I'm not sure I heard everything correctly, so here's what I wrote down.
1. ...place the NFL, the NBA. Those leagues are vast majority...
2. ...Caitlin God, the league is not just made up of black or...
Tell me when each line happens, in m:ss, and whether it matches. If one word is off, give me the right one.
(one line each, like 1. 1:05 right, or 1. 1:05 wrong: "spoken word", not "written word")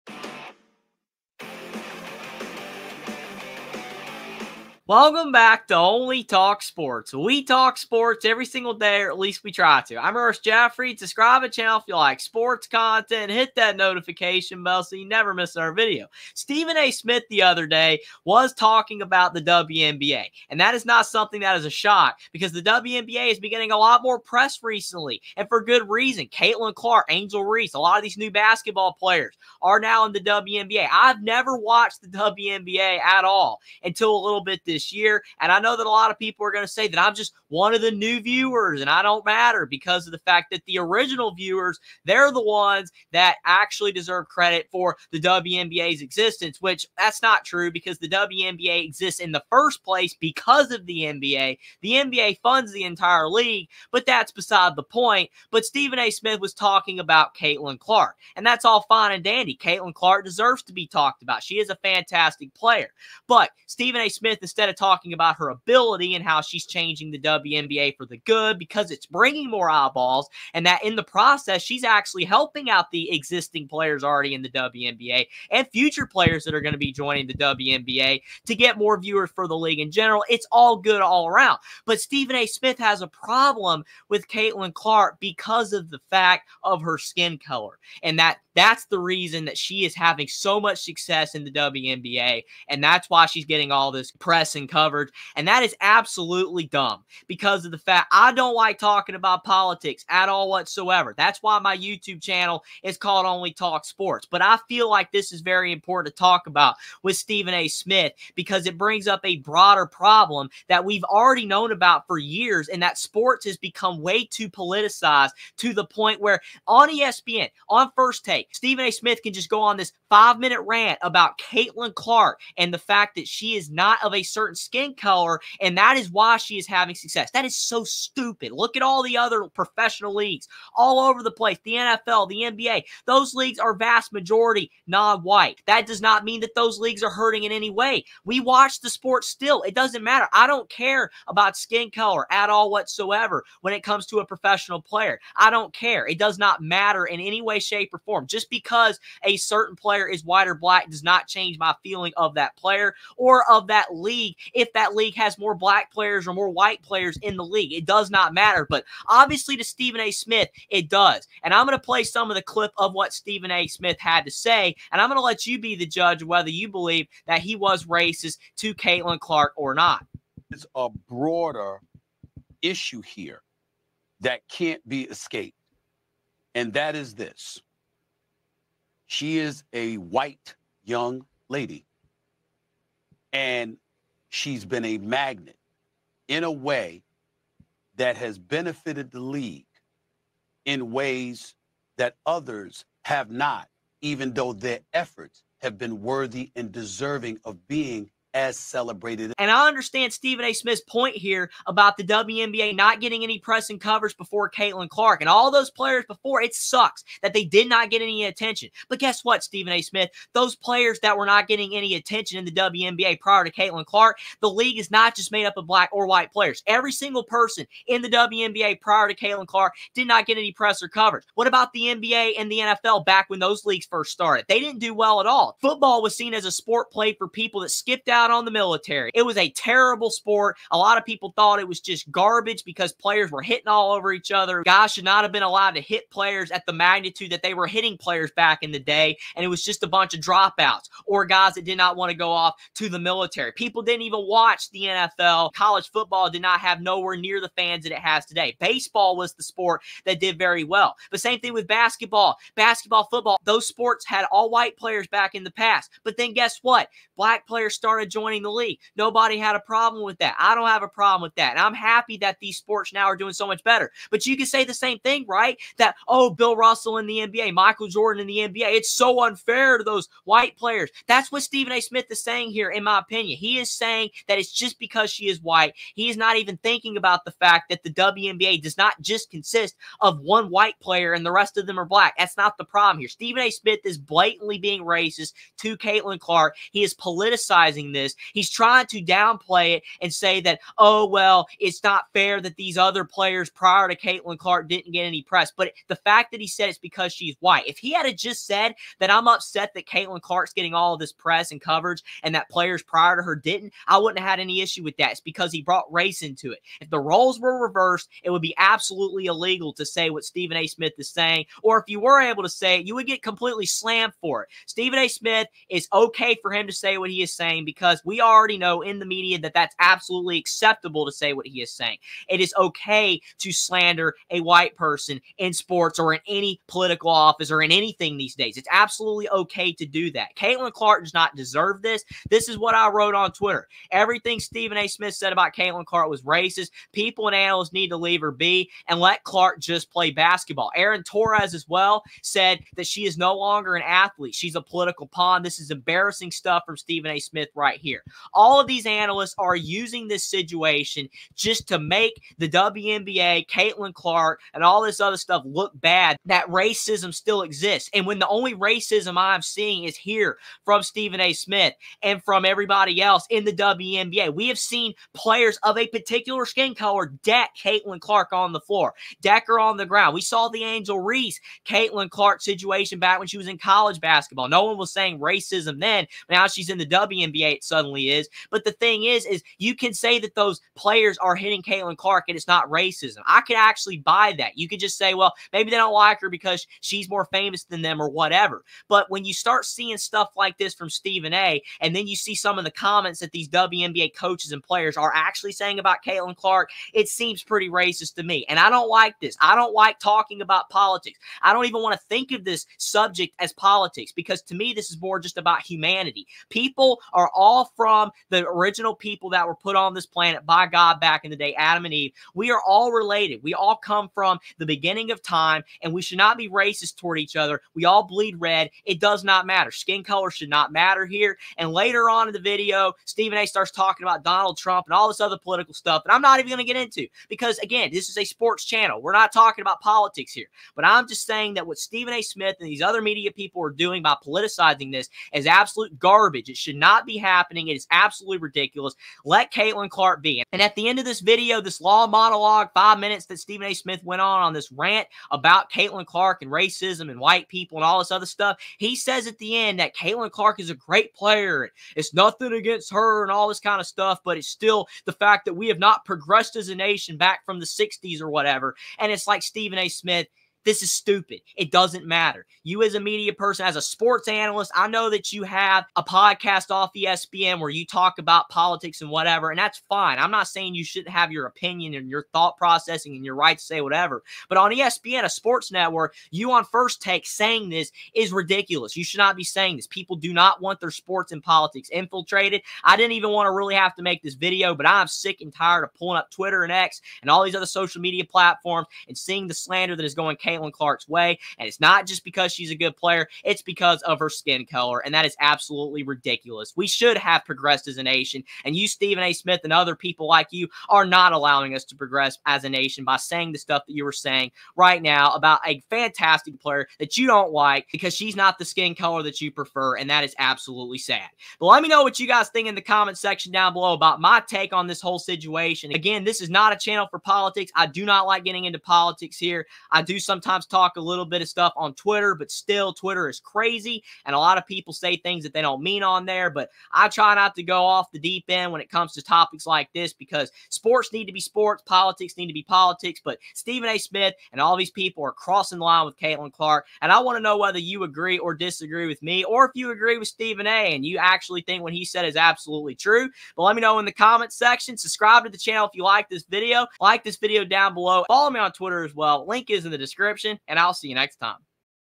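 1. 2:11 right
2. 3:33 wrong: "Clark", not "God".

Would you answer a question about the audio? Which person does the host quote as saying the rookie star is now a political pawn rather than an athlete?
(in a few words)
Aaron Torres.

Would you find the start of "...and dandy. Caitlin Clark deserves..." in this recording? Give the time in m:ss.
0:59.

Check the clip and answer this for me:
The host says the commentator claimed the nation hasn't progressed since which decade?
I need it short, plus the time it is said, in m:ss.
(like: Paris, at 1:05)
The 60s, at 7:37.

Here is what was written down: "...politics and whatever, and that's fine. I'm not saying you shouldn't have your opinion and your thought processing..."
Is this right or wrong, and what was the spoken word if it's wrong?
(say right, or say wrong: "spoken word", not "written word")
right.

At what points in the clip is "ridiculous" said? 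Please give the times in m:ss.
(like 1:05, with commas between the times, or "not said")
7:18, 7:58, 8:16.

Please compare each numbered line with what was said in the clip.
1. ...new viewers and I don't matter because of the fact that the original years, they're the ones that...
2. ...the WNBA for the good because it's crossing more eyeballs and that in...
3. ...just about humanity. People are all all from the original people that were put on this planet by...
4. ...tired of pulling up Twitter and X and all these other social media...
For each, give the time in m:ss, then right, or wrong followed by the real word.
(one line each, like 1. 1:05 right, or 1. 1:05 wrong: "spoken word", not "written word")
1. 0:37 wrong: "viewers", not "years"
2. 1:07 wrong: "bringing", not "crossing"
3. 6:45 right
4. 8:05 right.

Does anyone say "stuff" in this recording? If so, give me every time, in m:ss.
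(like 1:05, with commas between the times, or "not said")
5:46, 5:55, 6:29, 7:05, 7:28, 7:33, 8:23, 8:41.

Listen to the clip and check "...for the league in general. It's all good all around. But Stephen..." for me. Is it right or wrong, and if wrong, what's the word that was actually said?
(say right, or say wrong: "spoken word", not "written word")
right.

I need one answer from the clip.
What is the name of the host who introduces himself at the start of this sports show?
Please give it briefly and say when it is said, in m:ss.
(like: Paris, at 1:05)
Ernest Jaffrey, at 0:10.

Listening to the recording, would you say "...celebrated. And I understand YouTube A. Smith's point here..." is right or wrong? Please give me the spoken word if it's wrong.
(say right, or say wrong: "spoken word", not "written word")
wrong: "Stephen", not "YouTube".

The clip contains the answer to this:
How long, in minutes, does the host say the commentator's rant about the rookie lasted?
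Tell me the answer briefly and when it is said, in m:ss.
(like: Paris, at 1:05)
5 minutes, at 2:00.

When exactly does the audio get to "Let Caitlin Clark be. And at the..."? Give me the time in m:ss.
7:19.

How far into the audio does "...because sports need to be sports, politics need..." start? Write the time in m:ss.
8:50.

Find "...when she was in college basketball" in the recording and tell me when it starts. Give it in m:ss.
6:13.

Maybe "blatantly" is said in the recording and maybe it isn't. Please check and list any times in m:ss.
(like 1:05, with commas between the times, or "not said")
4:43.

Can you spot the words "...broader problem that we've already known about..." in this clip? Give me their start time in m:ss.
1:49.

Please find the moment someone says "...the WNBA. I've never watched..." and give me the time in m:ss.
0:30.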